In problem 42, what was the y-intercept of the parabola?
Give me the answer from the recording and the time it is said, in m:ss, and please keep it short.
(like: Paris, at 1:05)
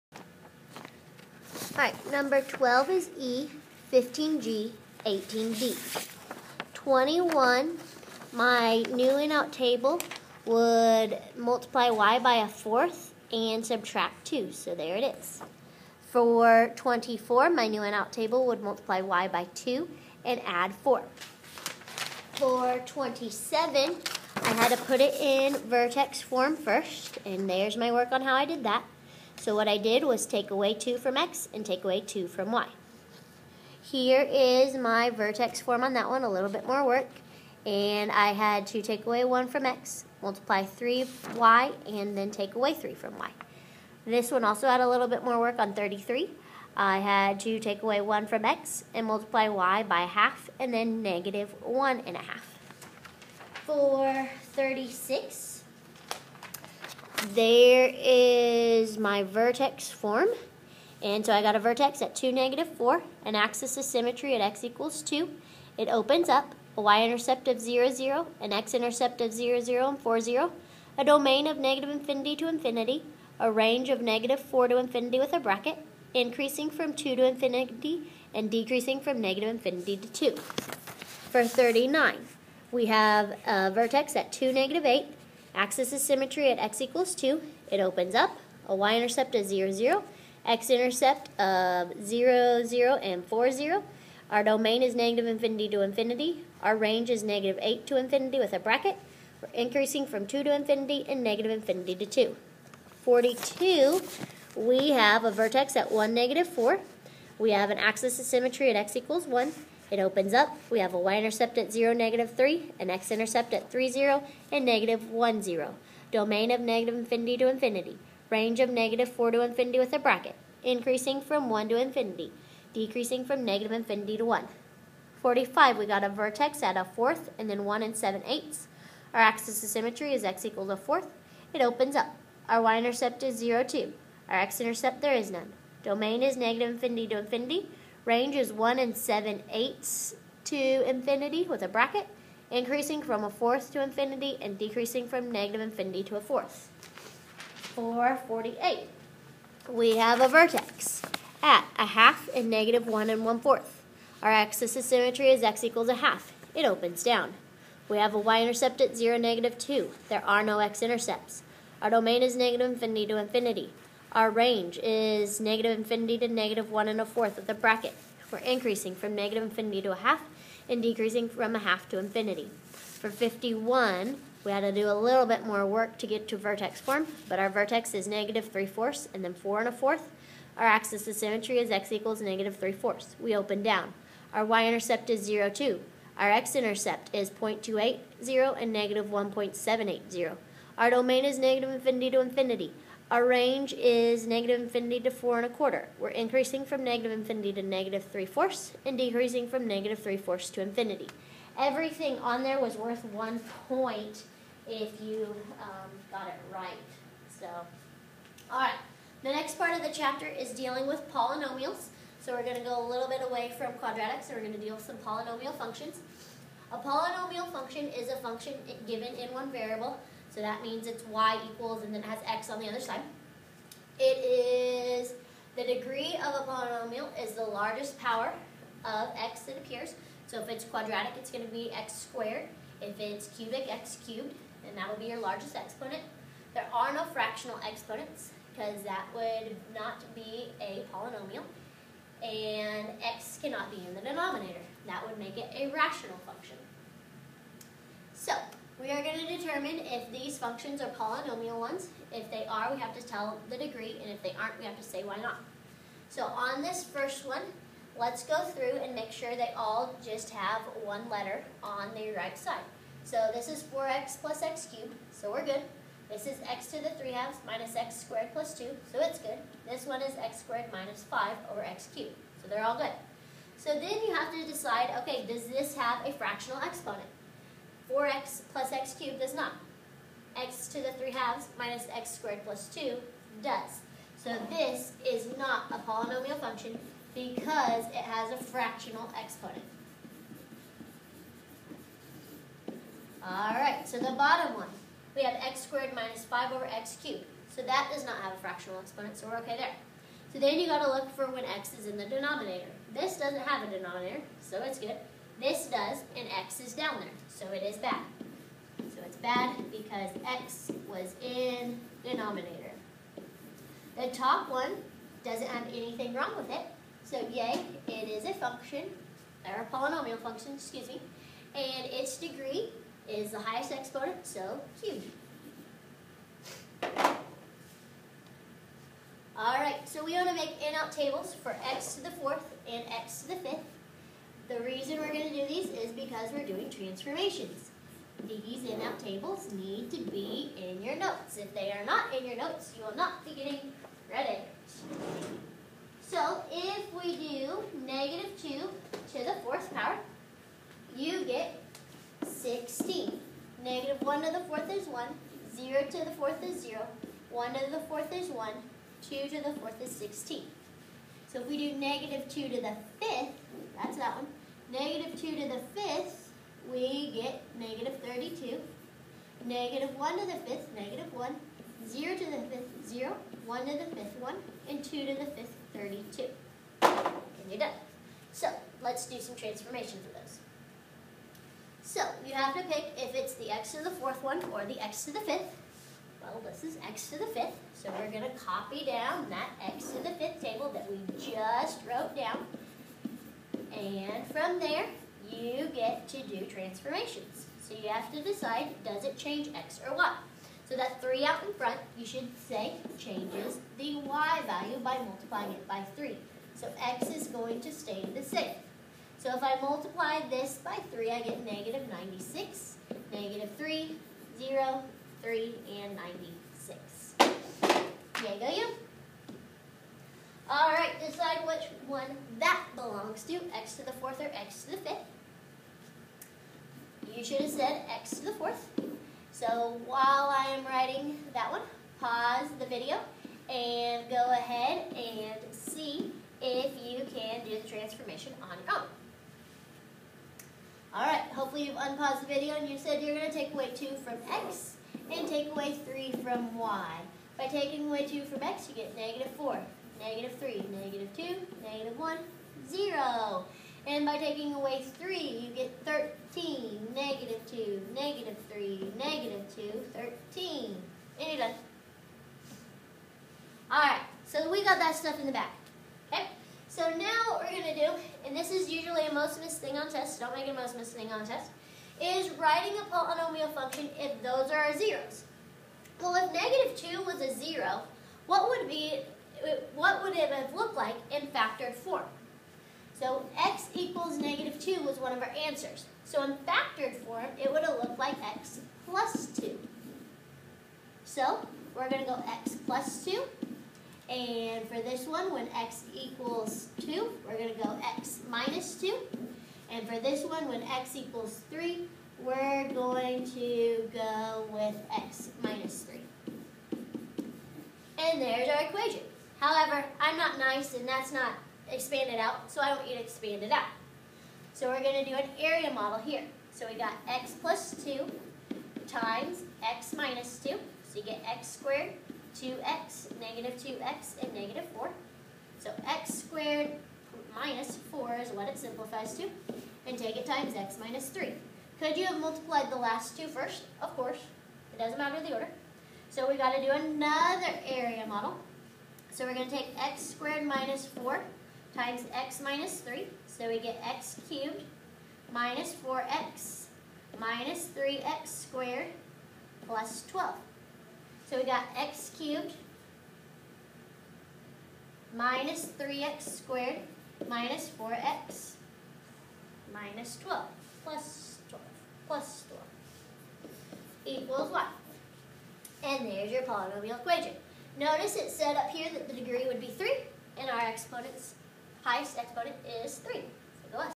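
(0, -3), at 1:51.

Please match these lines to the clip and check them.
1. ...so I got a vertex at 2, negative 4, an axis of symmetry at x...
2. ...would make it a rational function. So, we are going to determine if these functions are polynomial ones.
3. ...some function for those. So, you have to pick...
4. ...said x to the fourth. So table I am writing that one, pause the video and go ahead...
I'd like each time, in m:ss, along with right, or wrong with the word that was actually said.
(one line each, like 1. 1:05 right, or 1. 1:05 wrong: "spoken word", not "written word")
1. 1:01 right
2. 4:05 right
3. 6:19 wrong: "transformation", not "function"
4. 7:07 wrong: "while", not "table".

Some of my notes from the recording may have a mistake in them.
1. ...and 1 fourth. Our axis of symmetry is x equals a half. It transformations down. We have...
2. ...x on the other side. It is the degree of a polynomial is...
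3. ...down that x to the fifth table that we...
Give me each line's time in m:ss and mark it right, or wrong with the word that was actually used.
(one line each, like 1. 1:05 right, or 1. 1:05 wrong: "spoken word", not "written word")
1. 2:33 wrong: "opens", not "transformations"
2. 3:42 right
3. 6:28 right.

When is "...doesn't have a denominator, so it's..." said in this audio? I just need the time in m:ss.
5:03.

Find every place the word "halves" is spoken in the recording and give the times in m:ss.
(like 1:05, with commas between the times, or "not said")
4:27, 4:41.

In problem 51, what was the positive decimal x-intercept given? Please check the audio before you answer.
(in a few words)
0.280.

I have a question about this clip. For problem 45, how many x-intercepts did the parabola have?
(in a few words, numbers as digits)
None.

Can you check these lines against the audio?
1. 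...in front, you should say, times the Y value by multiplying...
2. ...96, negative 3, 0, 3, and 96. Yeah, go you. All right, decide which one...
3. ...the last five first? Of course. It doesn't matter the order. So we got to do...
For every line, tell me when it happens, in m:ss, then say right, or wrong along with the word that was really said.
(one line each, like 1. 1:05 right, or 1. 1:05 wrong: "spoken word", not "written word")
1. 6:41 wrong: "changes", not "times"
2. 6:51 right
3. 8:52 wrong: "two", not "five".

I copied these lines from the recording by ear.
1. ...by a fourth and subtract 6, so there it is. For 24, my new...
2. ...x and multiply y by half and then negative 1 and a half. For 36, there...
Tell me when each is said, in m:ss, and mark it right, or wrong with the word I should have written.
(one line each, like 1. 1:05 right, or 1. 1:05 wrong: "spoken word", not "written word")
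1. 0:12 wrong: "2", not "6"
2. 0:48 right.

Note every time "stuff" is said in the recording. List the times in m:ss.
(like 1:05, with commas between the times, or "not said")
7:44.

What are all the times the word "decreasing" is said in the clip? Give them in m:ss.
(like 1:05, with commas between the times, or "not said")
1:18, 2:02, 2:24, 2:50, 3:18.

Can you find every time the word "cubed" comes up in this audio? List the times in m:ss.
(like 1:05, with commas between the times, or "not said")
3:54, 4:24, 4:31, 4:38, 4:57, 5:24, 9:04, 9:12.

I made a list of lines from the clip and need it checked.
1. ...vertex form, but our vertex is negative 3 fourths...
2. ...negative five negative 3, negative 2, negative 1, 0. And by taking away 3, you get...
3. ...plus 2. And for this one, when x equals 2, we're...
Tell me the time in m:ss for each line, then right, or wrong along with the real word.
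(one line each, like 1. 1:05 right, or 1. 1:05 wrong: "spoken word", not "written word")
1. 2:56 right
2. 7:28 wrong: "four", not "five"
3. 8:12 right.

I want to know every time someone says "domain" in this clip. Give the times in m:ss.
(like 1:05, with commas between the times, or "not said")
1:11, 1:34, 1:56, 2:15, 2:41, 3:10.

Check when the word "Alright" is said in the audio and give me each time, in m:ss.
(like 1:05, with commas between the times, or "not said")
4:53, 5:29, 7:43.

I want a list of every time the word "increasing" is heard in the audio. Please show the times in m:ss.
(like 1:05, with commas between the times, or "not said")
1:16, 1:39, 2:00, 2:22, 2:48, 3:16.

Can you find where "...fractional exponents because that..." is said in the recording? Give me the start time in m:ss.
3:57.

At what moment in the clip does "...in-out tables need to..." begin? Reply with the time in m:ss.
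5:38.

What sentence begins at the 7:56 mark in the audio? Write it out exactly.
Well, if negative 2 was a 0, what would be uh, what would it have looked like in factored form?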